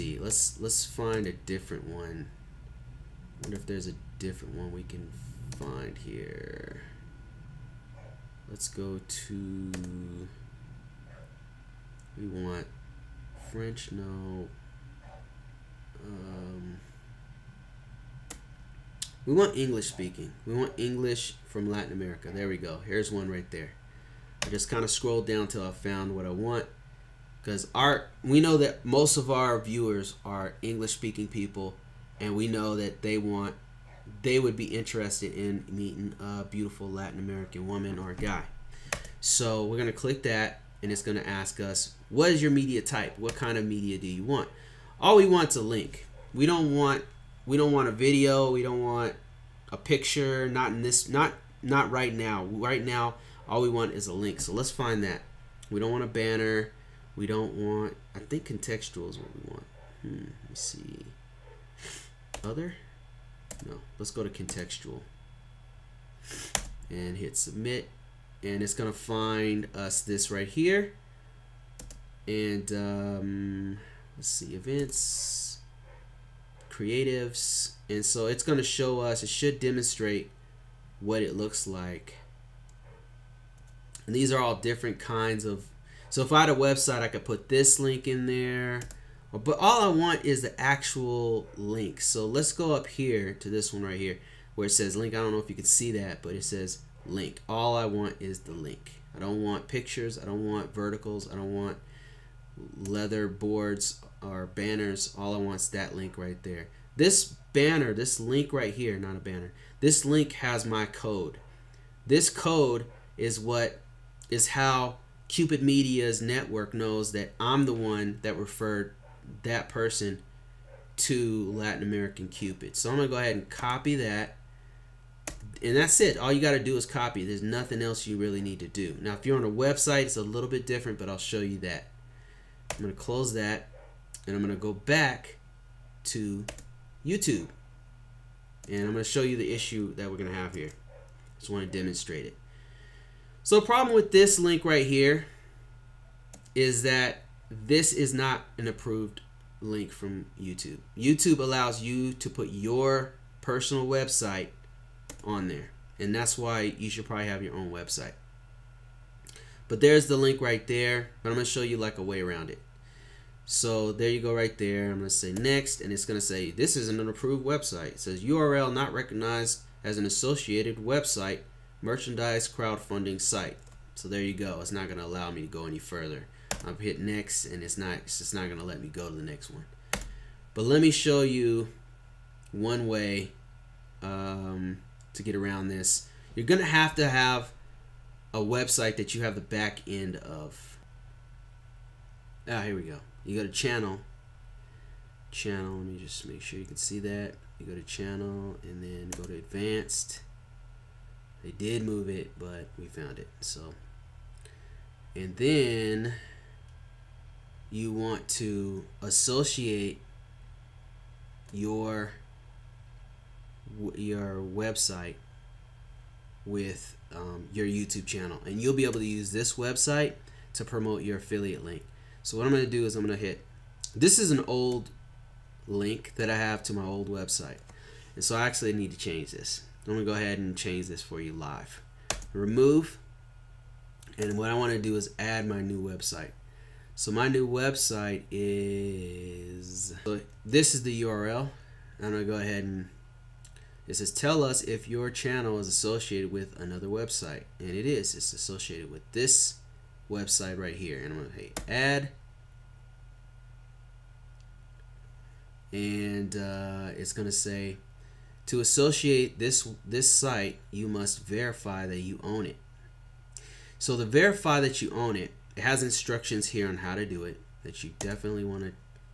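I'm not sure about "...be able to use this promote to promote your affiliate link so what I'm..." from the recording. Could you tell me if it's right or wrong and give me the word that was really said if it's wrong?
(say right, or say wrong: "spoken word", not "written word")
wrong: "website", not "promote".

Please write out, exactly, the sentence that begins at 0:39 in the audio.
So we're going to click that and it's going to ask us what is your media type?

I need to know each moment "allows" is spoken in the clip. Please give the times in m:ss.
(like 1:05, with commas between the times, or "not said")
2:31, 2:55.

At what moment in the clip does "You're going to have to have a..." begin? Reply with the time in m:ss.
3:06.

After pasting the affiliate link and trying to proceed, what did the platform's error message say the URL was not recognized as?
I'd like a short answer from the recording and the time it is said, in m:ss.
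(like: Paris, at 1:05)
An associated website, at 2:50.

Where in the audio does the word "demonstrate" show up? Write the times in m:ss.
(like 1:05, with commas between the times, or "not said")
1:19, 2:21.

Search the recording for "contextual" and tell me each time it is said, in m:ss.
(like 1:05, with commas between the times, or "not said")
0:58, 1:04.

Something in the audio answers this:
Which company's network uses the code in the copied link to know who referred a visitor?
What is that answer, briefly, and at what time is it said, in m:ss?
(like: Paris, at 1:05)
Cupid Media, at 1:55.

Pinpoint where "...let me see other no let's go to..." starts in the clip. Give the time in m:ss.
1:00.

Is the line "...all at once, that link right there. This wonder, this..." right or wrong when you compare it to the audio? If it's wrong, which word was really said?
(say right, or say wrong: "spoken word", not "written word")
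wrong: "banner", not "wonder".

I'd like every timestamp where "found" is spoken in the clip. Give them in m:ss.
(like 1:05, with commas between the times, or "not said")
0:25, 3:22.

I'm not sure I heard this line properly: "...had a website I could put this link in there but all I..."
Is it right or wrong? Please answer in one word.
right.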